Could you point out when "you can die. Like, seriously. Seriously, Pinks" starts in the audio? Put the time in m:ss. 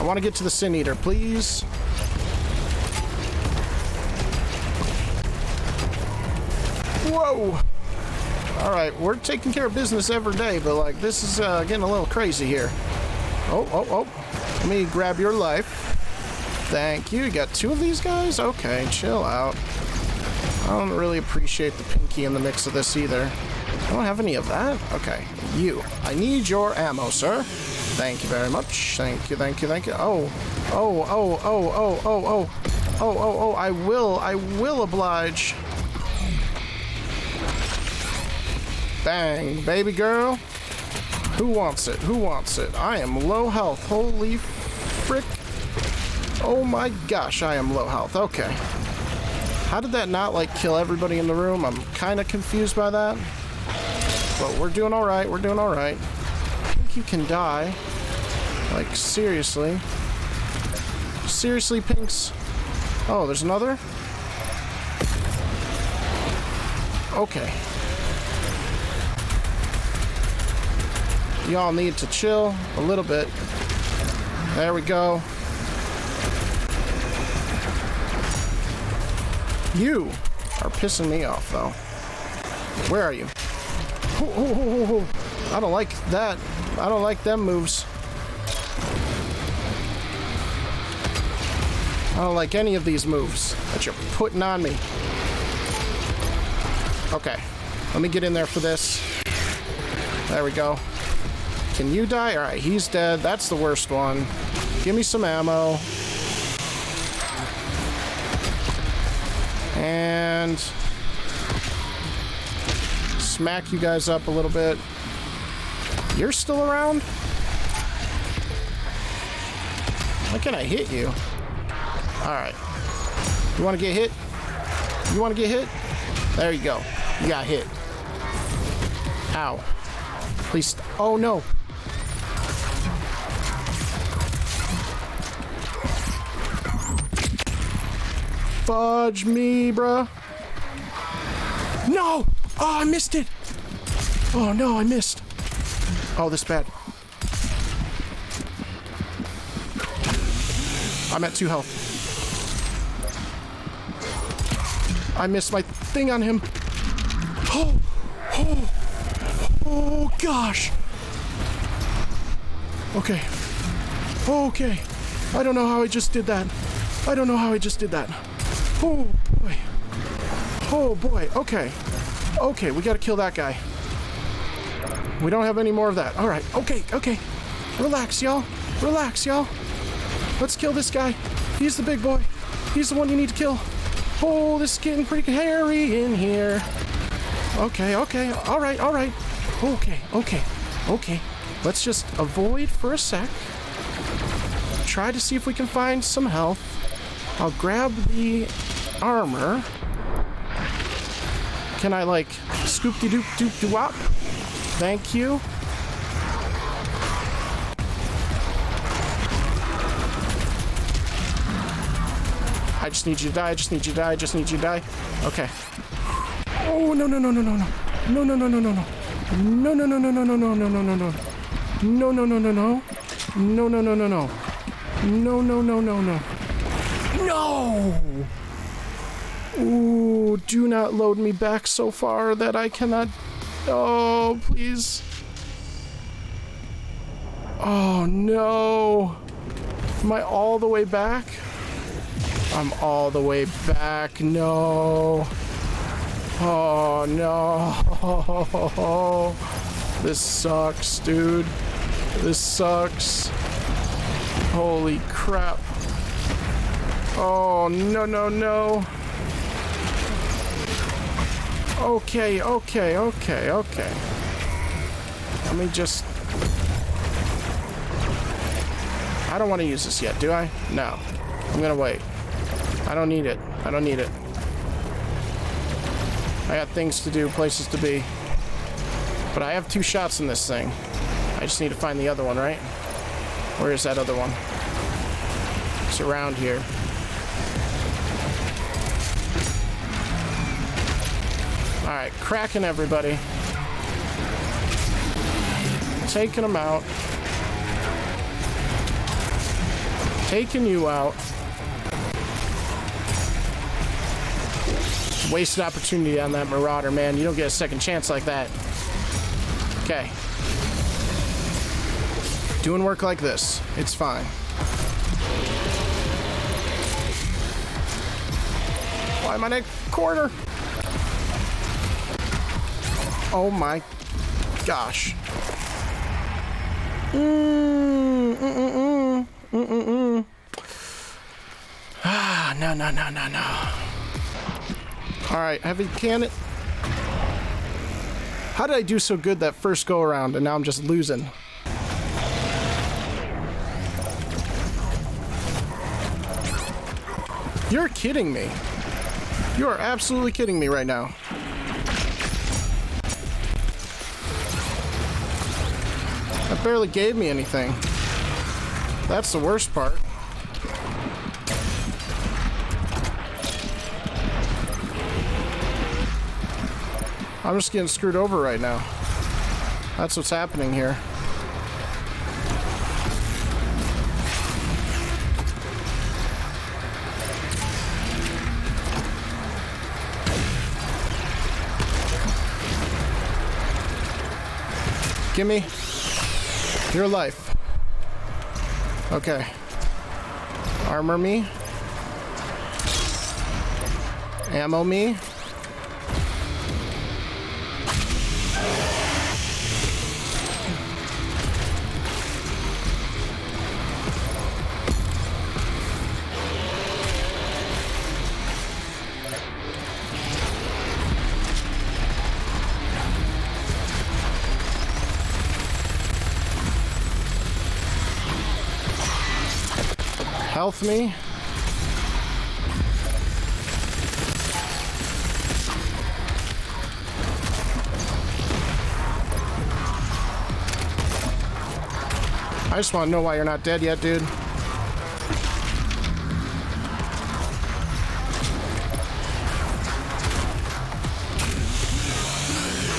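0:56.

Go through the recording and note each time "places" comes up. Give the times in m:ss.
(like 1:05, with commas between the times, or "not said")
4:37.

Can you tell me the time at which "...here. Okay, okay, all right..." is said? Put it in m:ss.
3:06.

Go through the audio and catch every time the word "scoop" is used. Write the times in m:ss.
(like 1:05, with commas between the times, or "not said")
3:22.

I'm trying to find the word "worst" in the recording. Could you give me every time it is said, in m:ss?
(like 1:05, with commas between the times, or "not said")
1:43, 5:59.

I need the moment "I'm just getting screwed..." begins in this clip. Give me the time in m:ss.
6:07.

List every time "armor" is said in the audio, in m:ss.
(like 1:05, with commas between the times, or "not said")
3:19, 6:30.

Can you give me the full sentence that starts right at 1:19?
You are pissing me off, though.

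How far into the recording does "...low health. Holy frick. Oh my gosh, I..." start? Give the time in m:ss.
0:43.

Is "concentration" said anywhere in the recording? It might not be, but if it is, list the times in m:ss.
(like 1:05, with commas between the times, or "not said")
not said.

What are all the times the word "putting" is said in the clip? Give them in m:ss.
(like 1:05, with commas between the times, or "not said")
1:34.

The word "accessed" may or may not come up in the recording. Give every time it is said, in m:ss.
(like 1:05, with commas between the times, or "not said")
not said.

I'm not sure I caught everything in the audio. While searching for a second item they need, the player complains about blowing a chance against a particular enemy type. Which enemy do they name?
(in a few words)
Marauder.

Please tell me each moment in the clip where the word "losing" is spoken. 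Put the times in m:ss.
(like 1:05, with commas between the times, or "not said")
5:40.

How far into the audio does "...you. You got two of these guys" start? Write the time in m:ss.
0:17.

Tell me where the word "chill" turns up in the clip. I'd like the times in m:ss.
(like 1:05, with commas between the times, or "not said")
0:18, 1:12.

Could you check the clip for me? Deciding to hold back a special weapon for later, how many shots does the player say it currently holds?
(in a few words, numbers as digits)
2 shots.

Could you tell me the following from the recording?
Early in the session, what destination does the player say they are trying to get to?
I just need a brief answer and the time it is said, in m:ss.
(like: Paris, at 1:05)
the Sin Eater, at 0:00.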